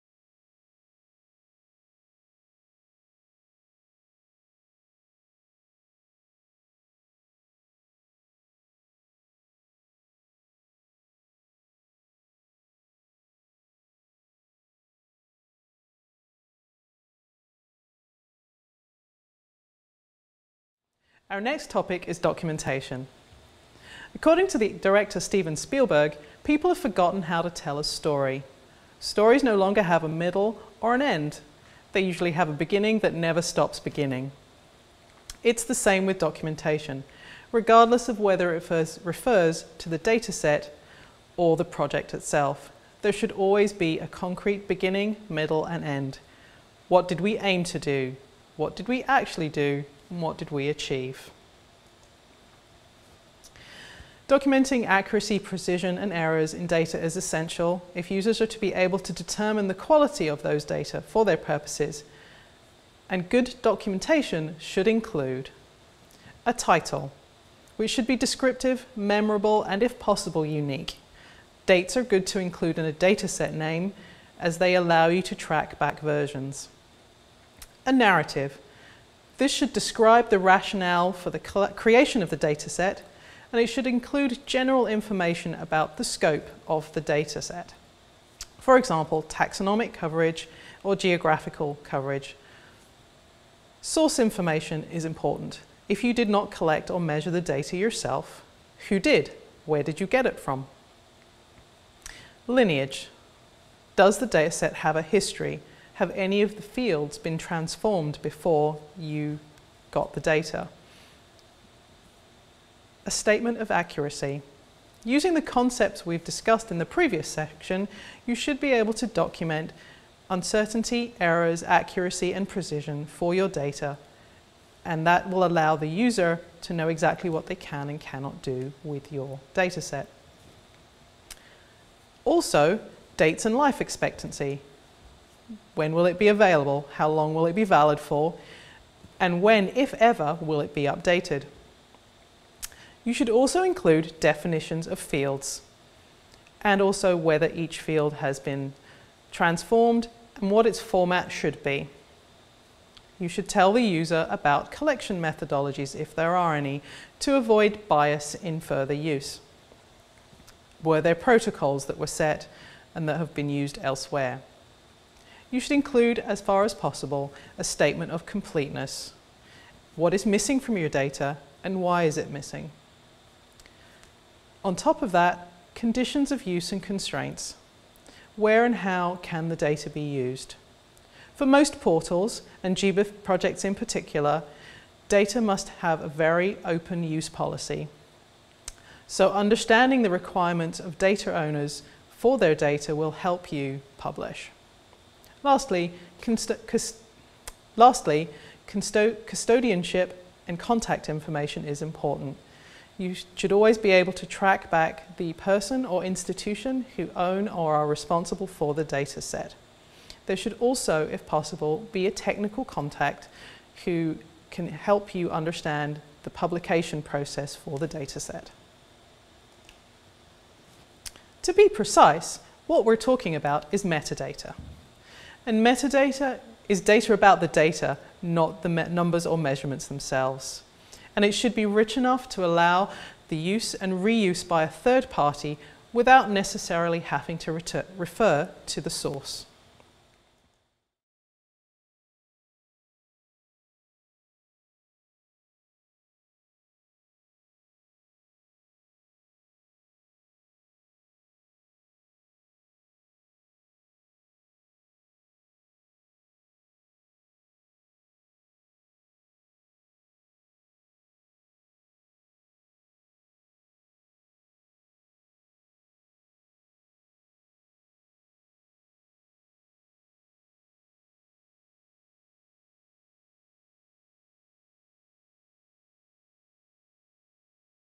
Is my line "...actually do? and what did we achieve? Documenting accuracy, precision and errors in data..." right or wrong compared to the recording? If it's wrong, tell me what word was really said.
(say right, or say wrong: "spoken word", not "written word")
right.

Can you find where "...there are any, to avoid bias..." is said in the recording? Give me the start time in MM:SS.
02:36.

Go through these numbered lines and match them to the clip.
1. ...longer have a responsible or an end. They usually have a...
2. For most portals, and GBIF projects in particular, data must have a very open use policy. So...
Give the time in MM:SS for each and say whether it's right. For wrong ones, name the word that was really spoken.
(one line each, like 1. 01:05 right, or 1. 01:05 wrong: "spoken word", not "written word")
1. 00:29 wrong: "middle", not "responsible"
2. 03:01 right.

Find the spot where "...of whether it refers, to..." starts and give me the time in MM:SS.
00:38.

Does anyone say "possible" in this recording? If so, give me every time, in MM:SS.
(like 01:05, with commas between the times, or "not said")
01:09, 02:46, 03:31.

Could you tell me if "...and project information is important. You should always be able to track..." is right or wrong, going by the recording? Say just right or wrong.
wrong.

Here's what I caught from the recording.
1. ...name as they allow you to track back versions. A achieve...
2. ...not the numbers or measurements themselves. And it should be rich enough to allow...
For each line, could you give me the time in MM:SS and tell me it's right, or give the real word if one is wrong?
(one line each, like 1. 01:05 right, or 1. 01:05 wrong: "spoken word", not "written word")
1. 01:13 wrong: "narrative", not "achieve"
2. 03:48 right.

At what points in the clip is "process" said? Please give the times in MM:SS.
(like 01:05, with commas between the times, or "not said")
03:37.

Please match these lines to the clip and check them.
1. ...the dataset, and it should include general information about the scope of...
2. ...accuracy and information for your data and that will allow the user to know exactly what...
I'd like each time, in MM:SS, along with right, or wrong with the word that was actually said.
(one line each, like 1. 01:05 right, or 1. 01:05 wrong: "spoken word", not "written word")
1. 01:22 right
2. 02:01 wrong: "precision", not "information".